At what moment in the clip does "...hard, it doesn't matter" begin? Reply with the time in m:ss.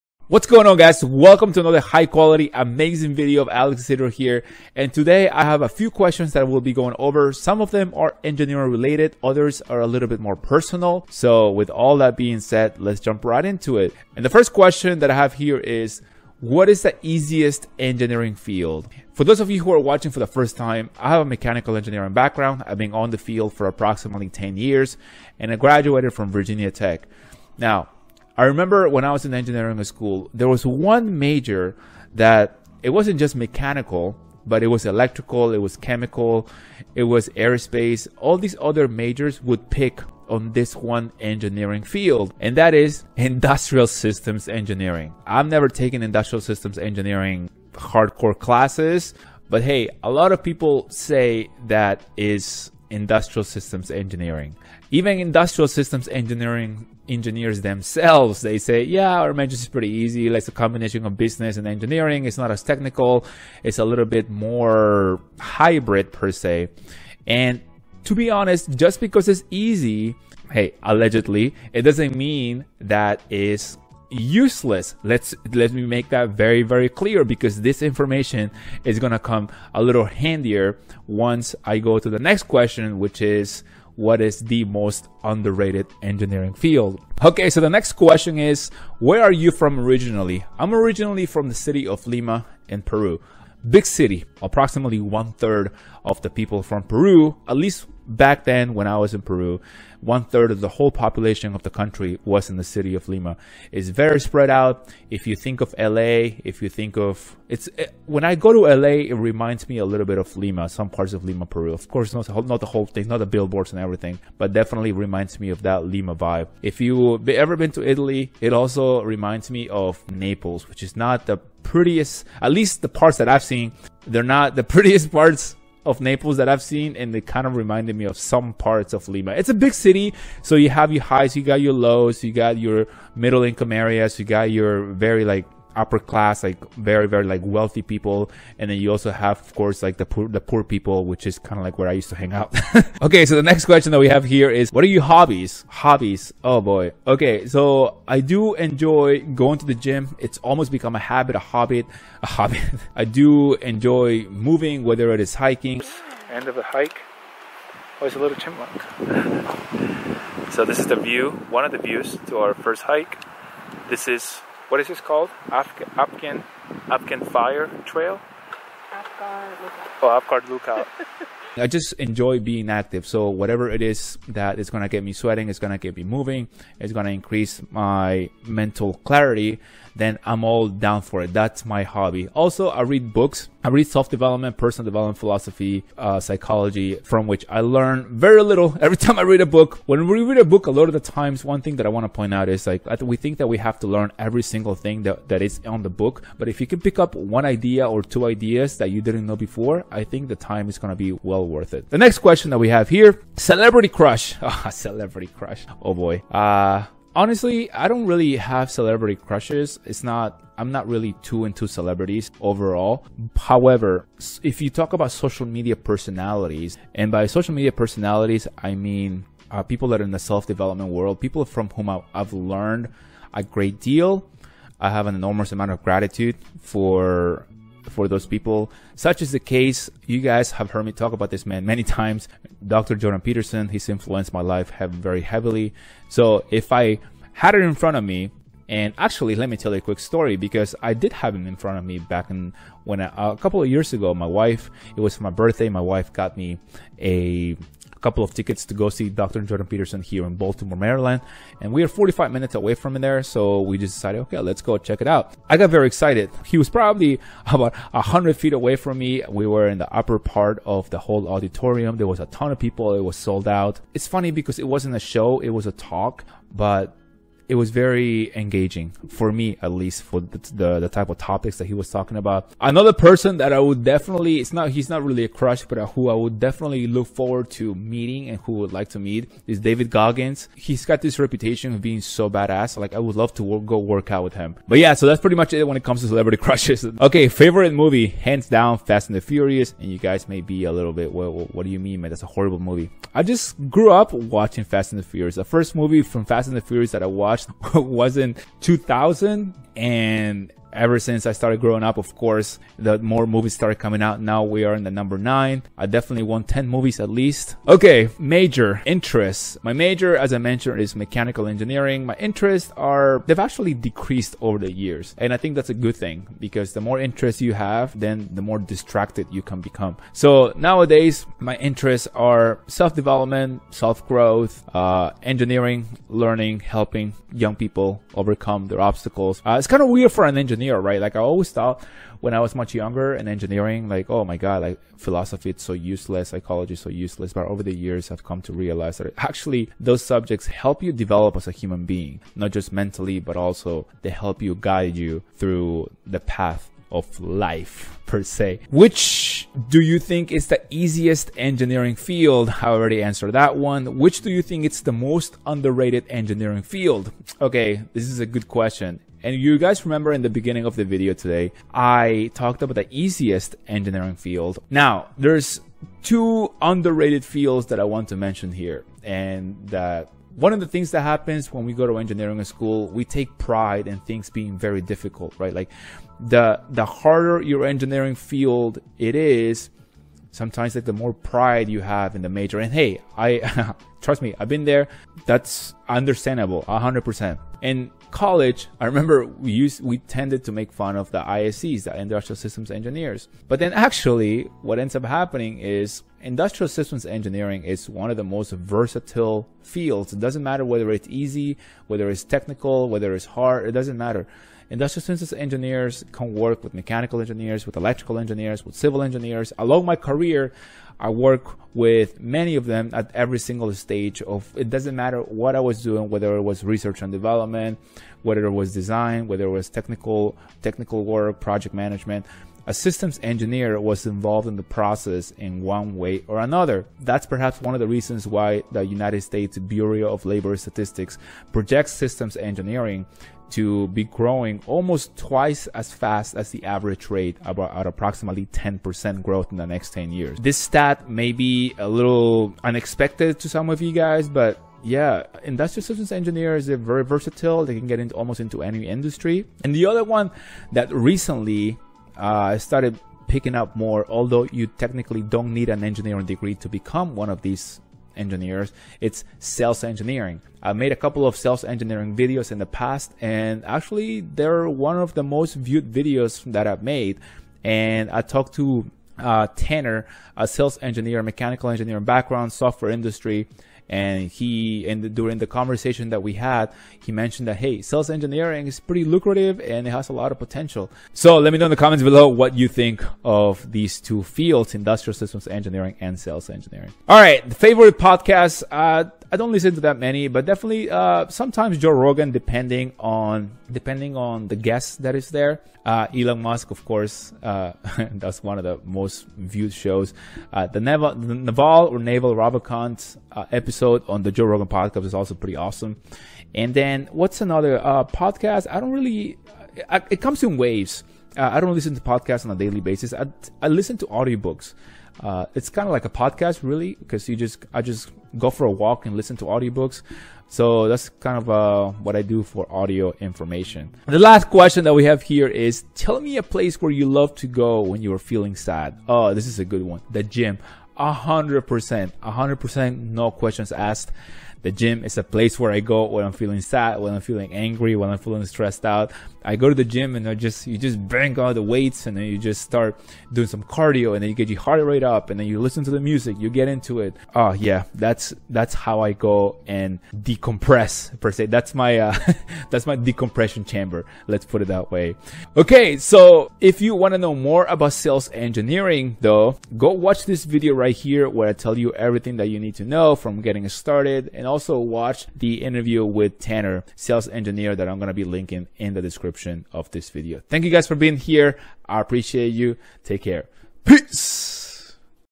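6:43.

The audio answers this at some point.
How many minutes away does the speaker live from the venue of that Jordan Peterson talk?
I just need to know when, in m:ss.
4:11.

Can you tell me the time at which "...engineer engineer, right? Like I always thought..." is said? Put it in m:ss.
5:30.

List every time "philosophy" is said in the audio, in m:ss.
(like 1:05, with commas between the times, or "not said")
3:05, 5:34.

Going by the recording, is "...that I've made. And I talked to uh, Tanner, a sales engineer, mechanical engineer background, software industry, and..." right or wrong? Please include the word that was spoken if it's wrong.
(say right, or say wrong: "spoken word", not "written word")
right.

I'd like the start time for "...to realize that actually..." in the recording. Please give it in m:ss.
5:38.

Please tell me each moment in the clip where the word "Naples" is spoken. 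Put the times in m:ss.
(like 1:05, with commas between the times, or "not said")
2:00, 2:05.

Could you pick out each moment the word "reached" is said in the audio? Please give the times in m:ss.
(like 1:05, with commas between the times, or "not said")
not said.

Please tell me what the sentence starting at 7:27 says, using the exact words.
They can get into almost into any industry.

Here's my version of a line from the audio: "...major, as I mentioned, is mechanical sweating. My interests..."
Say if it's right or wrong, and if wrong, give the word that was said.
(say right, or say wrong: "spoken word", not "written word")
wrong: "engineering", not "sweating".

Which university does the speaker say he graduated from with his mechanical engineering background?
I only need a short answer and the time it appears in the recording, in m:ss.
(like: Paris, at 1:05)
Virginia Tech, at 0:26.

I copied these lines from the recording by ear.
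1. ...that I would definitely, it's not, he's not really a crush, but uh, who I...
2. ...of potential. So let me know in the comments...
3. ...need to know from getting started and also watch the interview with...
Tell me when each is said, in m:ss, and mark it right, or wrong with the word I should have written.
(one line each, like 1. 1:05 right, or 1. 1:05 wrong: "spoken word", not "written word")
1. 4:33 right
2. 8:00 right
3. 9:22 right.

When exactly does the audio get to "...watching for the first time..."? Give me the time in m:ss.
0:19.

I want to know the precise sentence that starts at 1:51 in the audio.
Of course, not the whole, not the whole thing, not the billboards and everything, but definitely reminds me of that Lima vibe.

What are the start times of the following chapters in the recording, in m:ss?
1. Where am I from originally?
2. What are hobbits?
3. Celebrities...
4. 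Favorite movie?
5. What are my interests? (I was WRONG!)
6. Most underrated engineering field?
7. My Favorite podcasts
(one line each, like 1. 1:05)
1. 1:28
2. 2:22
3. 3:20
4. 4:46
5. 5:08
6. 5:48
7. 8:07.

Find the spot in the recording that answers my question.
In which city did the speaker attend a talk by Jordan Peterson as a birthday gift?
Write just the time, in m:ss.
4:10.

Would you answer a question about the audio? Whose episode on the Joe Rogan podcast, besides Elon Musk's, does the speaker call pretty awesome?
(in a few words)
Naval Ravikant.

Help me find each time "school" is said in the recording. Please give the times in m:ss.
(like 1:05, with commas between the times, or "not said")
0:29, 6:12.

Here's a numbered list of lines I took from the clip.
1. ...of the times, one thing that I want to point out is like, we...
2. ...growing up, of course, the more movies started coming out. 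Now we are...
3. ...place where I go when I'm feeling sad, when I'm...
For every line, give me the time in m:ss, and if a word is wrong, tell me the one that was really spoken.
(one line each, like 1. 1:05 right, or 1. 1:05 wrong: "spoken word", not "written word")
1. 3:10 right
2. 5:01 right
3. 8:55 right.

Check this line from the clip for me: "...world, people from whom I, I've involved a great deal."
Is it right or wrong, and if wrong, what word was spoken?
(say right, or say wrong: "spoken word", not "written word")
wrong: "learned", not "involved".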